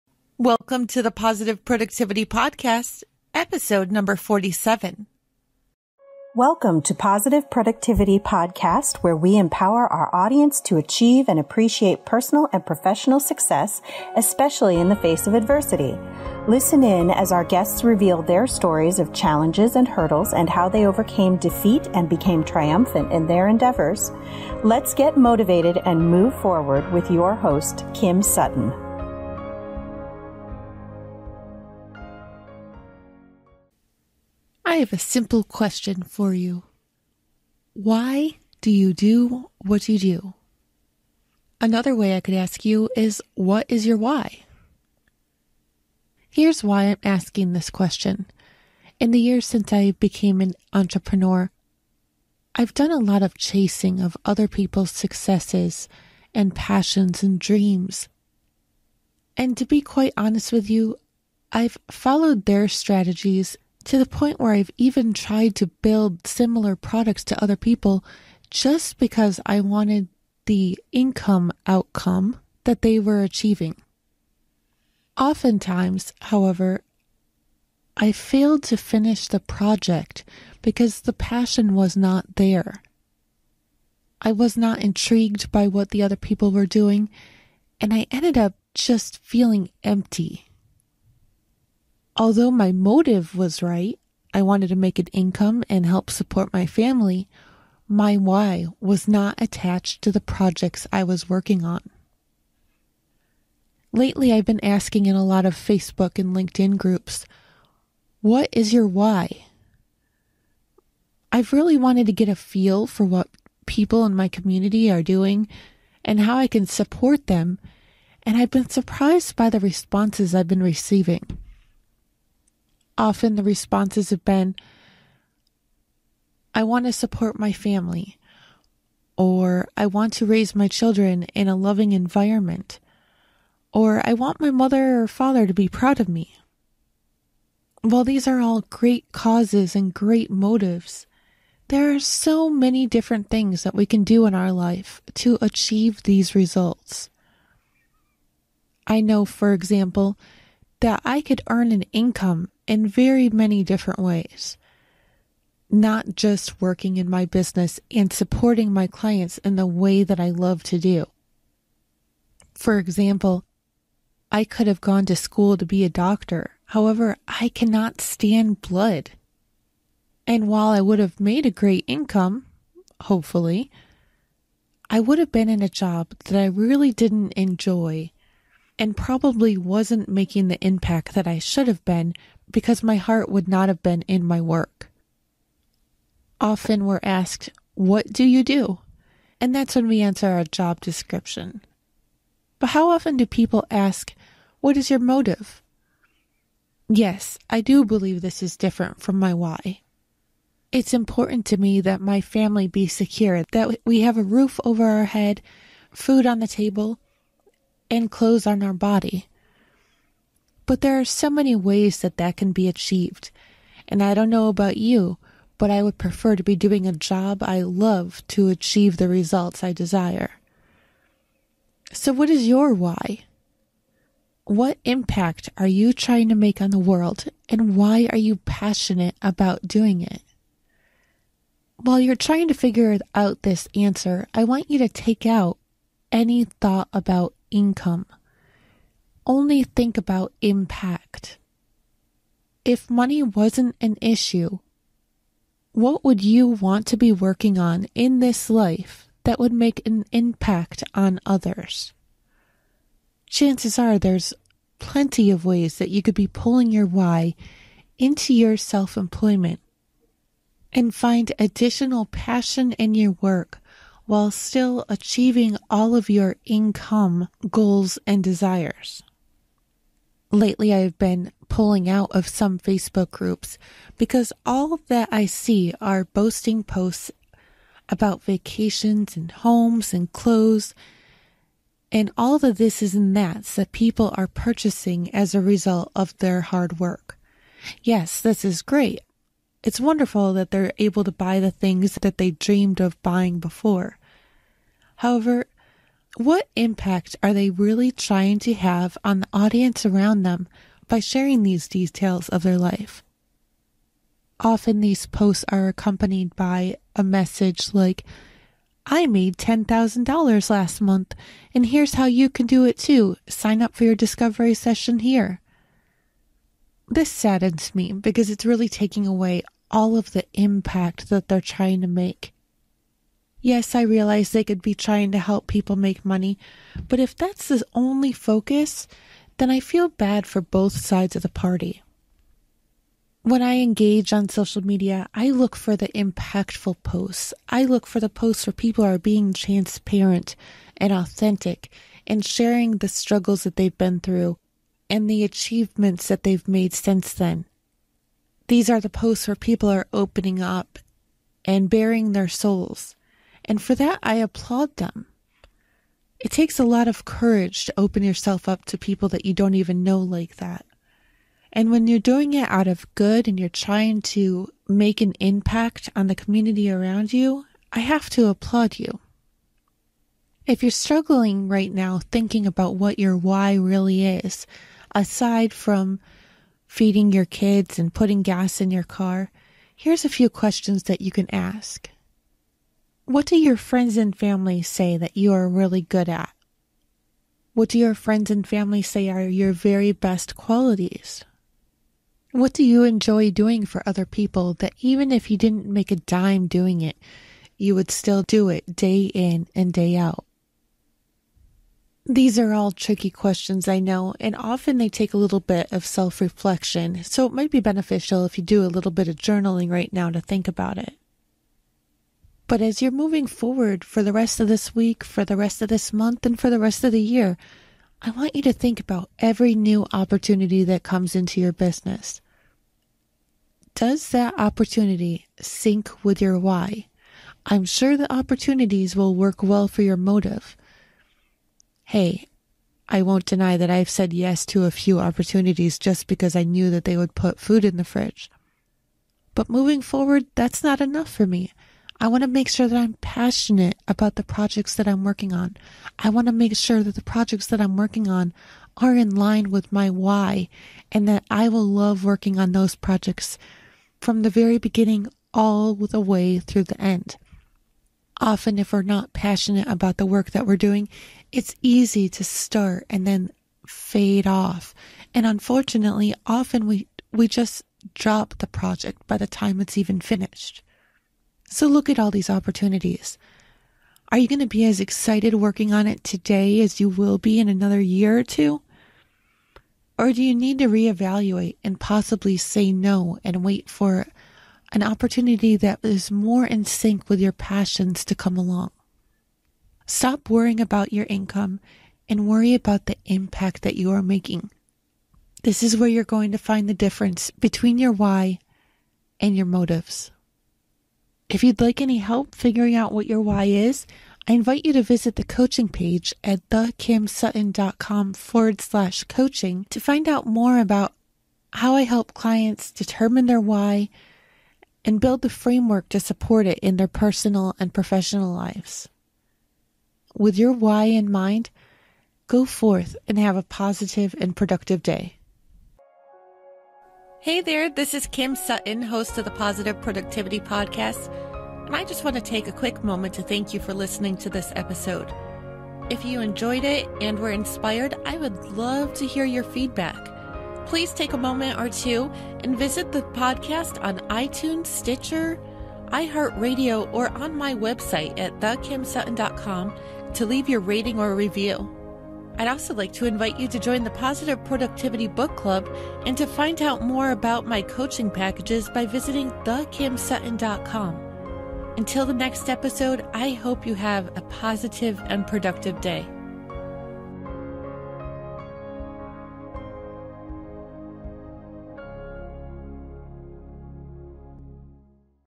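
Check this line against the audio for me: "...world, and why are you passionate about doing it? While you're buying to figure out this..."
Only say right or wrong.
wrong.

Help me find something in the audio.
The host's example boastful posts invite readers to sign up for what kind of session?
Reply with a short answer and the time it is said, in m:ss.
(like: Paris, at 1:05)
Discovery session, at 5:13.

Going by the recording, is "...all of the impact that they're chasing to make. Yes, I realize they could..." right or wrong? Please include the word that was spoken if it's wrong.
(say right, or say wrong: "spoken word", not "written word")
wrong: "trying", not "chasing".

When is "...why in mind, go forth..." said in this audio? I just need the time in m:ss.
8:40.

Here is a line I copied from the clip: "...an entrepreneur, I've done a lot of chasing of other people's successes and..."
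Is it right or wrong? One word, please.
right.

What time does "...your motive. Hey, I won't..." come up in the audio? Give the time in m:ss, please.
7:09.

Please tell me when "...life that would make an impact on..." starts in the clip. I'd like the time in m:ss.
4:08.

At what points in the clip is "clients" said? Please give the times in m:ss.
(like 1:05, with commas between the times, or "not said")
2:38, 8:32.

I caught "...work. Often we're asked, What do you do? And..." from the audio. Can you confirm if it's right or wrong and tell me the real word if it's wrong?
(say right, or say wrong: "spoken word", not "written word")
right.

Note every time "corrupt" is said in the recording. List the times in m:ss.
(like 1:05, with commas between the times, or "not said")
not said.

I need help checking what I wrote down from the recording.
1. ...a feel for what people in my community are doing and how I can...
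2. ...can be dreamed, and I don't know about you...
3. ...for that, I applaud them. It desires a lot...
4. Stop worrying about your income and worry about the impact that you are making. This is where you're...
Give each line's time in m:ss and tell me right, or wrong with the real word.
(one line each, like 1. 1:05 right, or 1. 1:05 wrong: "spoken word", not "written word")
1. 1:52 right
2. 3:32 wrong: "achieved", not "dreamed"
3. 5:53 wrong: "takes", not "desires"
4. 8:09 right.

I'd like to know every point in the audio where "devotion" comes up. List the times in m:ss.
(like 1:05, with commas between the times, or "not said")
not said.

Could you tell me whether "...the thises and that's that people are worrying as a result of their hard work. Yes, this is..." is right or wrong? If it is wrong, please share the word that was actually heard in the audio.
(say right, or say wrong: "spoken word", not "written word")
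wrong: "purchasing", not "worrying".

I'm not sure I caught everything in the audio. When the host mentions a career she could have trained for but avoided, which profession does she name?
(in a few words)
Doctor.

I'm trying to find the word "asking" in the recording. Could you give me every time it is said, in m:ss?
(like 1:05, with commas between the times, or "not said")
0:47, 1:44.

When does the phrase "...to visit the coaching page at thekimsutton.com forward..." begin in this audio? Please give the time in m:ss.
8:24.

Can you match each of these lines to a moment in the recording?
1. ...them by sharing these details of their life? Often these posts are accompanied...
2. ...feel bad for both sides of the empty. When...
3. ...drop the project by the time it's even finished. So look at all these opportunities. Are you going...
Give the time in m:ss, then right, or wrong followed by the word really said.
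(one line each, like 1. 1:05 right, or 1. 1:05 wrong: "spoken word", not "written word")
1. 5:00 right
2. 5:29 wrong: "party", not "empty"
3. 7:47 right.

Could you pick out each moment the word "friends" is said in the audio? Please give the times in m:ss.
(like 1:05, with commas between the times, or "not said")
6:23, 6:27.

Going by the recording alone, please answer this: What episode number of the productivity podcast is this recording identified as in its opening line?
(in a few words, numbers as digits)
47.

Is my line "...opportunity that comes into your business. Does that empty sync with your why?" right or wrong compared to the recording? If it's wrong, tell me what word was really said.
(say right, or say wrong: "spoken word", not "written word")
wrong: "opportunity", not "empty".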